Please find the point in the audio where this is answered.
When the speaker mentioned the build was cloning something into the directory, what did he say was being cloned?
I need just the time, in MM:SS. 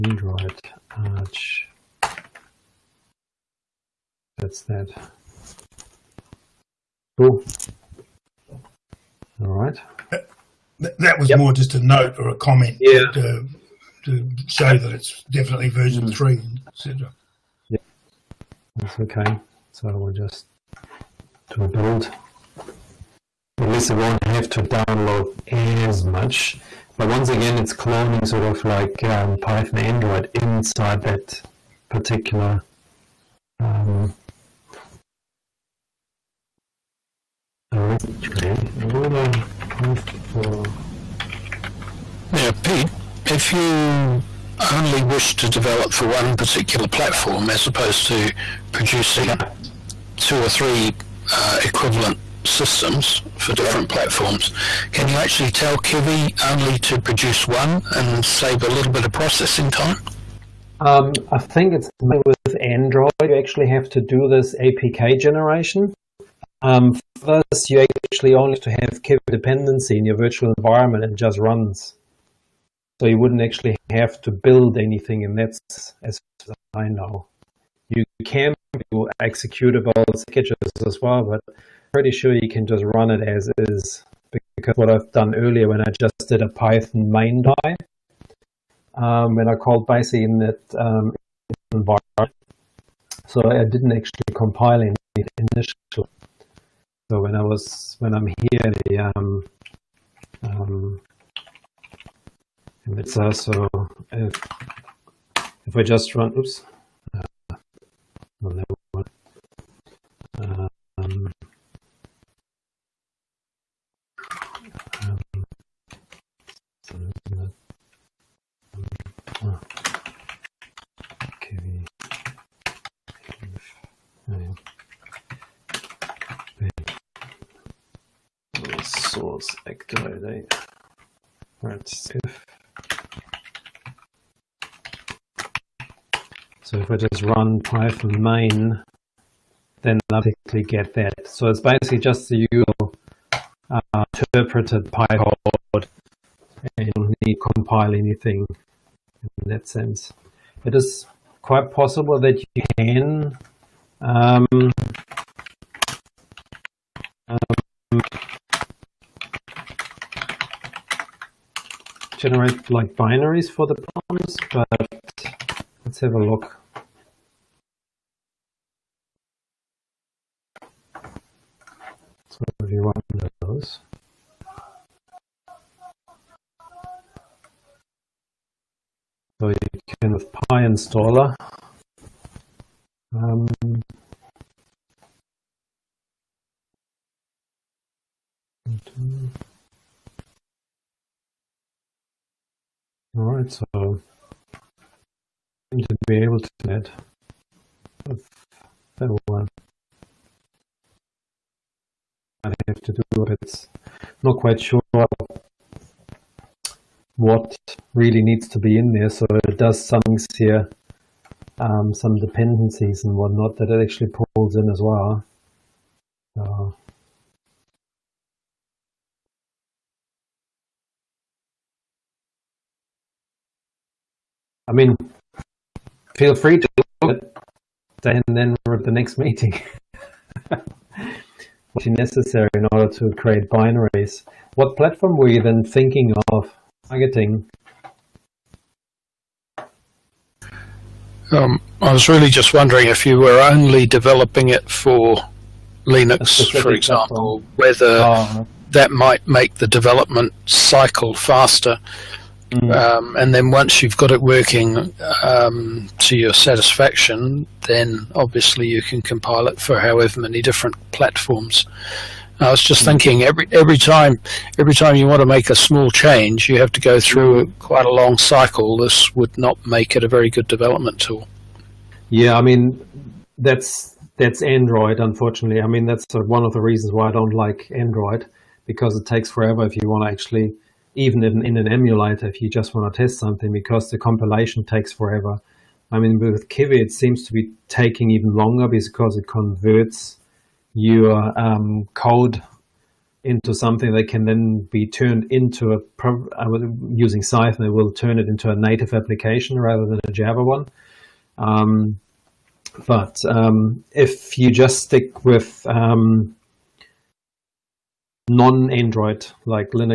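00:29.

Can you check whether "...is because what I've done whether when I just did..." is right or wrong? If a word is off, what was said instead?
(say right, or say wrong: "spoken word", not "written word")
wrong: "earlier", not "whether".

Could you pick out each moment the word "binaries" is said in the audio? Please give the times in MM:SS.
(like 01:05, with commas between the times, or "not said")
02:42, 03:53.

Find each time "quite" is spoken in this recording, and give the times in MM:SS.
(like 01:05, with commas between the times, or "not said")
02:31, 03:24, 04:27.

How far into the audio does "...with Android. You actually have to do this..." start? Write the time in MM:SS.
01:02.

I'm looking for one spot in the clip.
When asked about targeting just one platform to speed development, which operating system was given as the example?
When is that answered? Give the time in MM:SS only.
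04:05.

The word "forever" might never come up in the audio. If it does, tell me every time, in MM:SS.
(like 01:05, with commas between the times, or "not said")
04:39, 04:44.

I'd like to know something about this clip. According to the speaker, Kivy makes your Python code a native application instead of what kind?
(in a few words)
Java.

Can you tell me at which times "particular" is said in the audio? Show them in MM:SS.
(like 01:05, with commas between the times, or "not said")
00:31, 00:46.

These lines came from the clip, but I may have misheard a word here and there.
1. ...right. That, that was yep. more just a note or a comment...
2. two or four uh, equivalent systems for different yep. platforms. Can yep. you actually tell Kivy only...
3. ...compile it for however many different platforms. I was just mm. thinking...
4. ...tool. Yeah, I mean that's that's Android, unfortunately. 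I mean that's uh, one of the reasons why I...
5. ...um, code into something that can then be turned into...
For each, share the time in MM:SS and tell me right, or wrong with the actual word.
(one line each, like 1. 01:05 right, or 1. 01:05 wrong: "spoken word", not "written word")
1. 00:09 right
2. 00:50 wrong: "three", not "four"
3. 04:19 right
4. 04:31 right
5. 04:51 right.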